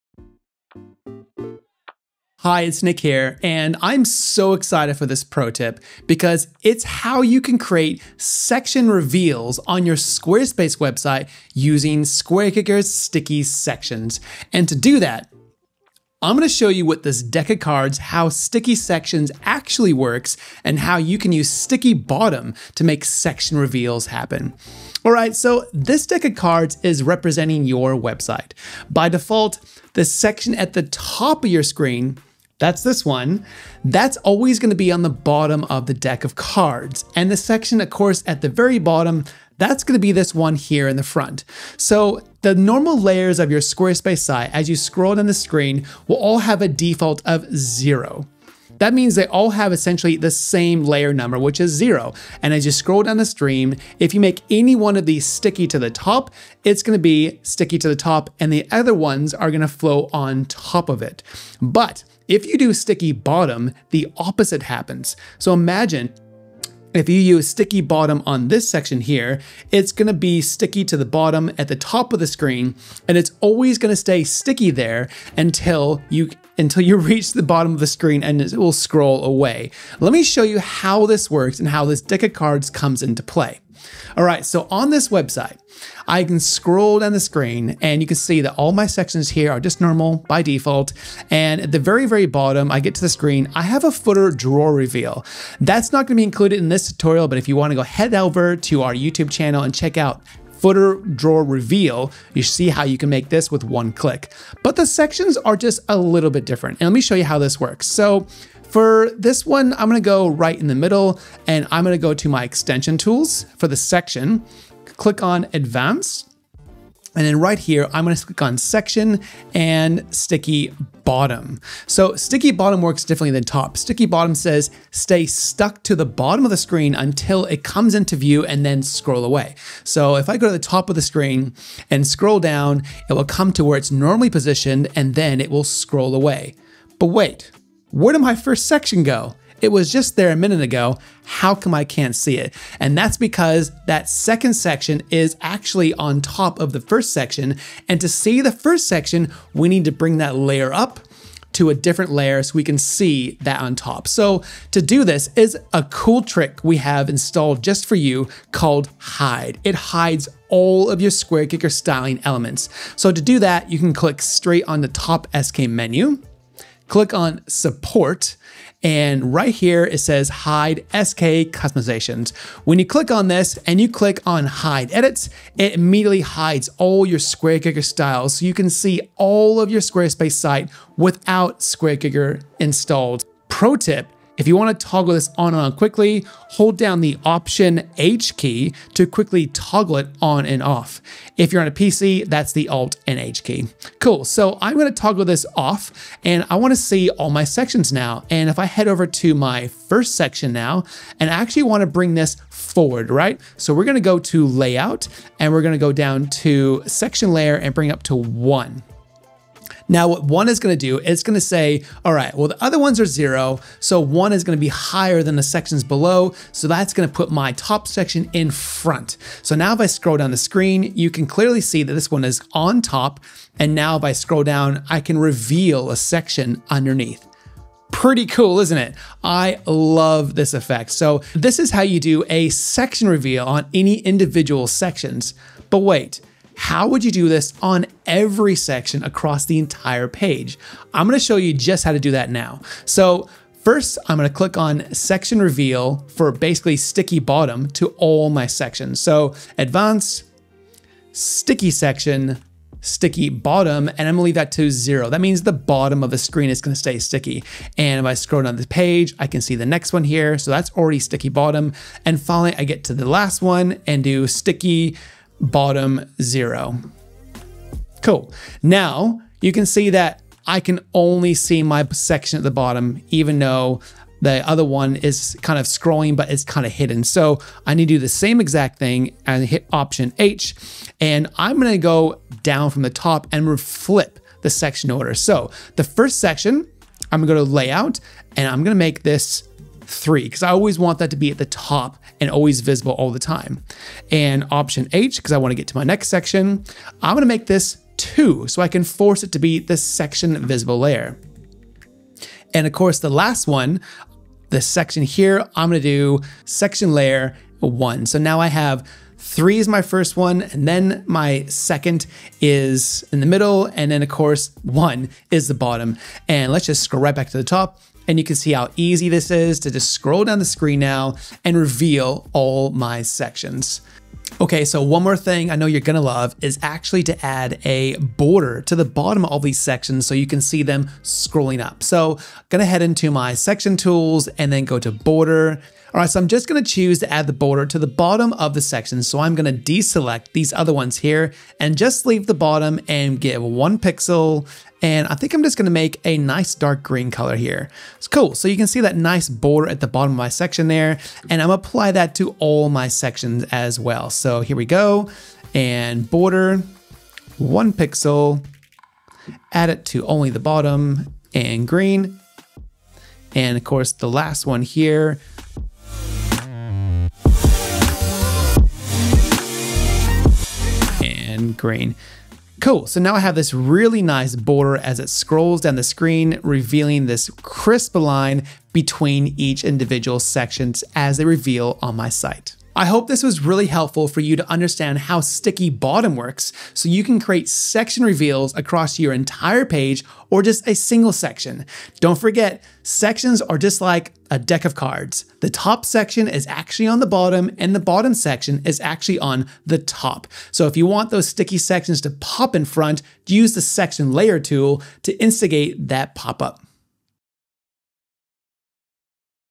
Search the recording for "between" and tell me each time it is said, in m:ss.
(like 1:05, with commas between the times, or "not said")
6:18.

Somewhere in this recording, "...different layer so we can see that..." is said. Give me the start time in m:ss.
2:31.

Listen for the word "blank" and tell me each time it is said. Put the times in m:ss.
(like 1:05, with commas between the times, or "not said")
not said.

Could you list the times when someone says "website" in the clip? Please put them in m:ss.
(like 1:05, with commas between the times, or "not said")
0:10, 0:27, 1:25.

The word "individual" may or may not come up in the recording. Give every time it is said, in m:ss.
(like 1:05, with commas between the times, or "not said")
3:53, 6:19.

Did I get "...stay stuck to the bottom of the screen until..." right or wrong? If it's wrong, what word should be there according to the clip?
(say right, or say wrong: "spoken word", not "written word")
right.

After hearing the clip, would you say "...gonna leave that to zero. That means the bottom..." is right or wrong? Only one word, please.
right.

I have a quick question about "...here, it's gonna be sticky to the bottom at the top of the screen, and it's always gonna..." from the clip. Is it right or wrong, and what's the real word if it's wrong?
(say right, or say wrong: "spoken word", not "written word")
right.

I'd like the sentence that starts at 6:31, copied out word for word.
Don't forget, sections are just like a deck of cards.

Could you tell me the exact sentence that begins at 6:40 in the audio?
So if you want those sticky sections to pop in front, use the section layer tool to instigate that pop up.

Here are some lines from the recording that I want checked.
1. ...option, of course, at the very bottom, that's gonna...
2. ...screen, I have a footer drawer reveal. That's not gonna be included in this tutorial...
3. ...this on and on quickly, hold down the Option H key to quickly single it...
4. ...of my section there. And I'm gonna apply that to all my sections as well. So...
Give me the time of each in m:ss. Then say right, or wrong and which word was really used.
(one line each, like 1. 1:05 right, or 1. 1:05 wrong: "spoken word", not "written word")
1. 0:37 wrong: "section", not "option"
2. 1:33 right
3. 3:05 wrong: "toggle", not "single"
4. 5:50 right.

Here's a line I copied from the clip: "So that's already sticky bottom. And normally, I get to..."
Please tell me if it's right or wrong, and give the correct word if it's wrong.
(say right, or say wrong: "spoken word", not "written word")
wrong: "finally", not "normally".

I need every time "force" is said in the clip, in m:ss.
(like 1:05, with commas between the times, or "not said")
4:58.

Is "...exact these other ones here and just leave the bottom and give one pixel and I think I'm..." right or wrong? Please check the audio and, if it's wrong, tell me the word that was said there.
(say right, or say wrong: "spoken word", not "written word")
wrong: "deselect", not "exact".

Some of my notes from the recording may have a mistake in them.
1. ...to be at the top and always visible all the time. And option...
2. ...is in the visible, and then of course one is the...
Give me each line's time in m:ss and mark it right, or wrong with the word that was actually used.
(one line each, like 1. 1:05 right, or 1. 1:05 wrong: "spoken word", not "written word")
1. 4:51 right
2. 5:12 wrong: "middle", not "visible".